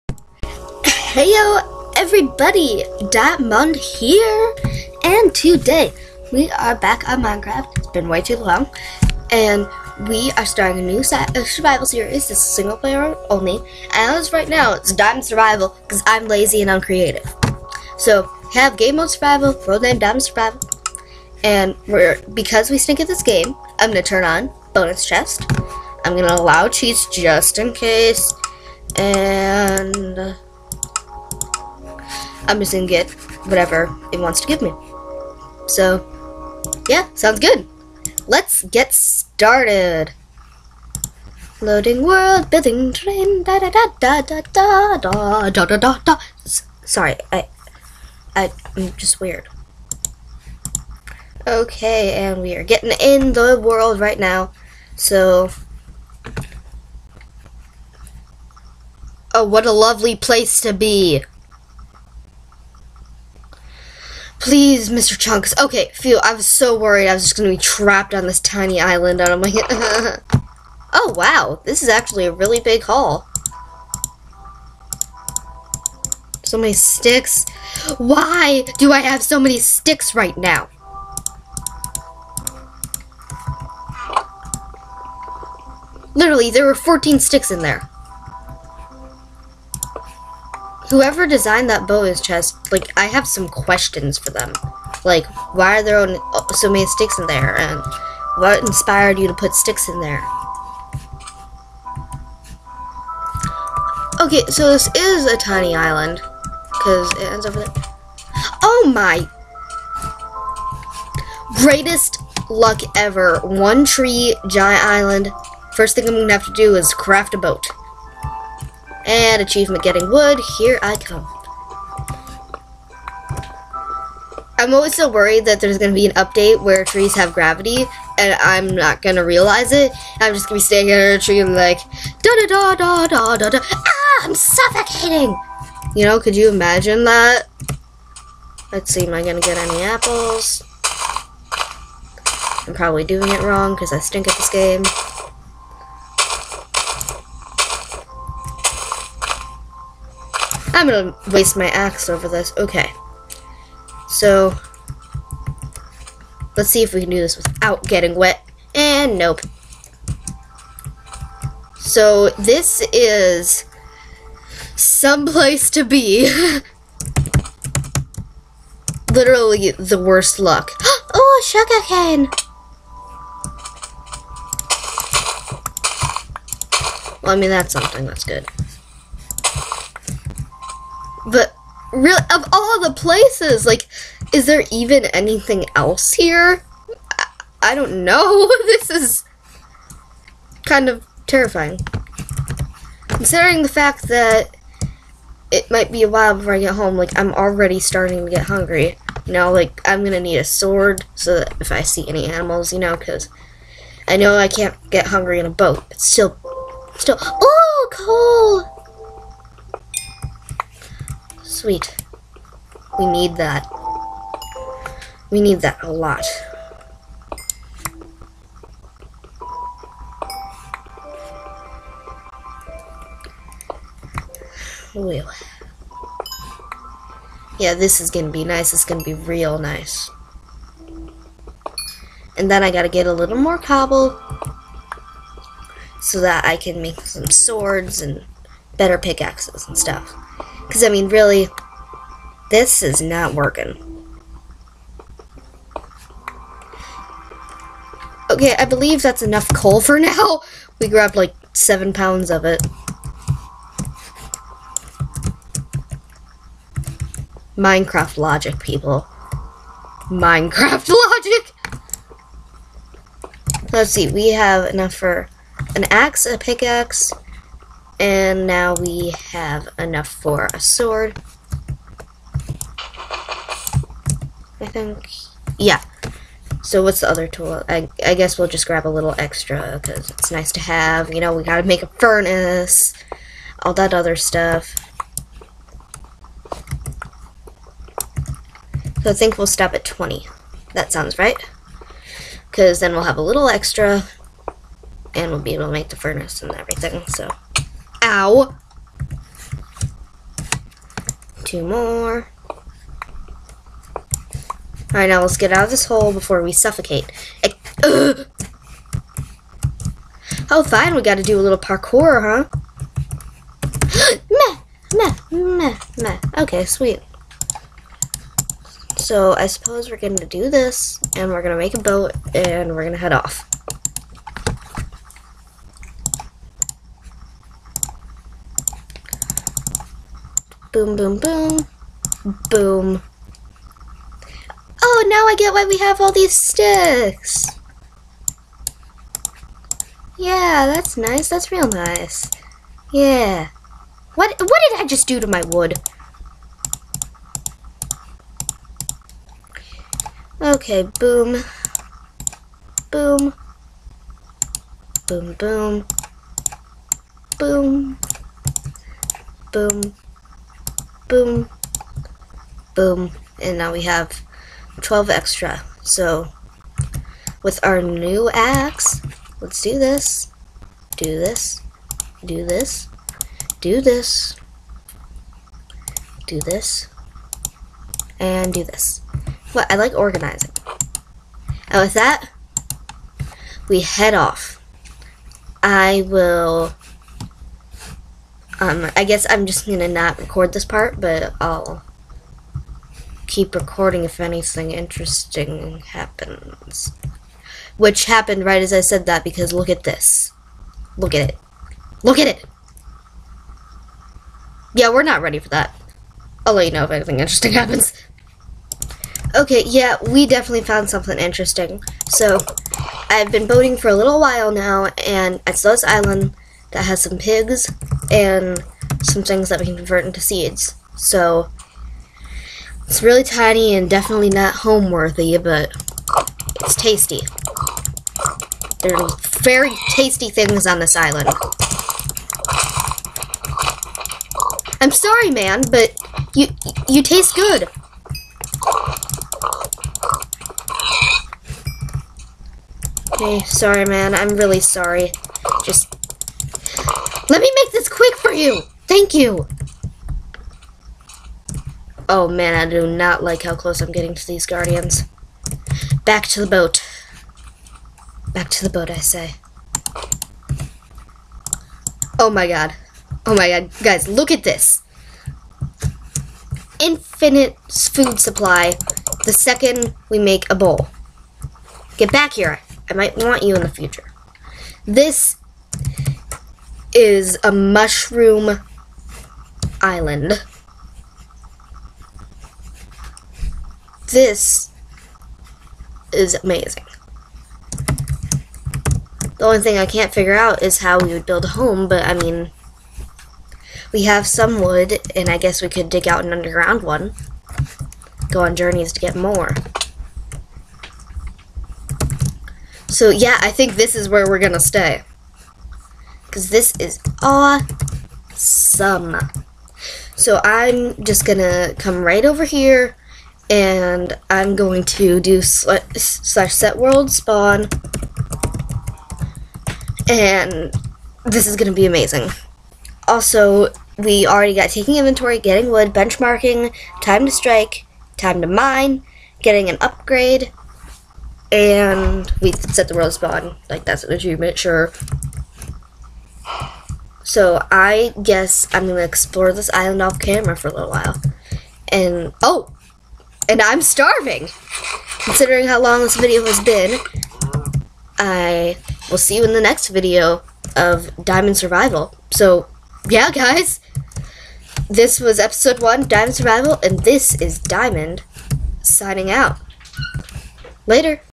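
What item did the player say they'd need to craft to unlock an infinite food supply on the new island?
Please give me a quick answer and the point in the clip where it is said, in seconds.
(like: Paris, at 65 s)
a bowl, at 470 s.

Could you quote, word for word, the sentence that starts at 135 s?
You know, could you imagine that?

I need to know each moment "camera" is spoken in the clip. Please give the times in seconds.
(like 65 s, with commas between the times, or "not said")
540 s.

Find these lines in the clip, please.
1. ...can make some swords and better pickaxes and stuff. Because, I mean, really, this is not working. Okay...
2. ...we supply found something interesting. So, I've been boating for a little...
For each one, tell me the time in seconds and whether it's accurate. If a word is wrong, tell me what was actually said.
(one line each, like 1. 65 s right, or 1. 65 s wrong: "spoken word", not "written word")
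1. 236 s right
2. 410 s wrong: "definitely", not "supply".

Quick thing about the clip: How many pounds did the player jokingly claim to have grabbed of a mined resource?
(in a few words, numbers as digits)
7.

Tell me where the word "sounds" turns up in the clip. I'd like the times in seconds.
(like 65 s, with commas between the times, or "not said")
37 s, 290 s.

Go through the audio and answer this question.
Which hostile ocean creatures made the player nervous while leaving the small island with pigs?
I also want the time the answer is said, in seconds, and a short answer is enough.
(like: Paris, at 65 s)
guardians, at 454 s.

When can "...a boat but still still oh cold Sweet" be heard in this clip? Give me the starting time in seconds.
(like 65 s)
205 s.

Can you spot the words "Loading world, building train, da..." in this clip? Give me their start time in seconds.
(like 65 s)
41 s.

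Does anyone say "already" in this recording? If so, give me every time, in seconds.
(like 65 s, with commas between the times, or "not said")
197 s, 524 s.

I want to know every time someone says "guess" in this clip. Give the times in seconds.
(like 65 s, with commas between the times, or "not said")
278 s, 389 s, 495 s, 538 s.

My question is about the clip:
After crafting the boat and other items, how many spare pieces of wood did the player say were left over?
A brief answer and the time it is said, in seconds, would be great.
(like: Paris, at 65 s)
12, at 364 s.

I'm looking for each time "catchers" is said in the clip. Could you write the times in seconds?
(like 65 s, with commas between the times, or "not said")
not said.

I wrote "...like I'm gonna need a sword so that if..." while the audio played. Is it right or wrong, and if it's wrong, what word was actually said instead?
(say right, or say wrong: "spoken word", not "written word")
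right.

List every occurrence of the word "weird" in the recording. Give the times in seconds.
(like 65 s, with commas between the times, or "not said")
49 s.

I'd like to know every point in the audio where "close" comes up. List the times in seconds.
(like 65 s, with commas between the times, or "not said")
453 s.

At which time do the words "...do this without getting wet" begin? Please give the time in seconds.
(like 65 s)
157 s.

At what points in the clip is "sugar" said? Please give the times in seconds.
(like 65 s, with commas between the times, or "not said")
171 s.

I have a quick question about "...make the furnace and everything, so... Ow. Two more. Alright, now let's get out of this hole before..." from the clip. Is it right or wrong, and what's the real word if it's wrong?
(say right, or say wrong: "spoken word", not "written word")
right.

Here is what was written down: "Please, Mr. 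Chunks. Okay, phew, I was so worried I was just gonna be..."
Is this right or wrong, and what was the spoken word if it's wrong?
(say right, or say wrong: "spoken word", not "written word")
right.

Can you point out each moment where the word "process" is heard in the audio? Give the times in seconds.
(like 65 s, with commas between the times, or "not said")
not said.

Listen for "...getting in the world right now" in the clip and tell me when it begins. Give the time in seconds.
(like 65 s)
52 s.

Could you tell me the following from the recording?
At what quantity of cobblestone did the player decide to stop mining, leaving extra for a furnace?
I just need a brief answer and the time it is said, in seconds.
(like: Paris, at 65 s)
20, at 289 s.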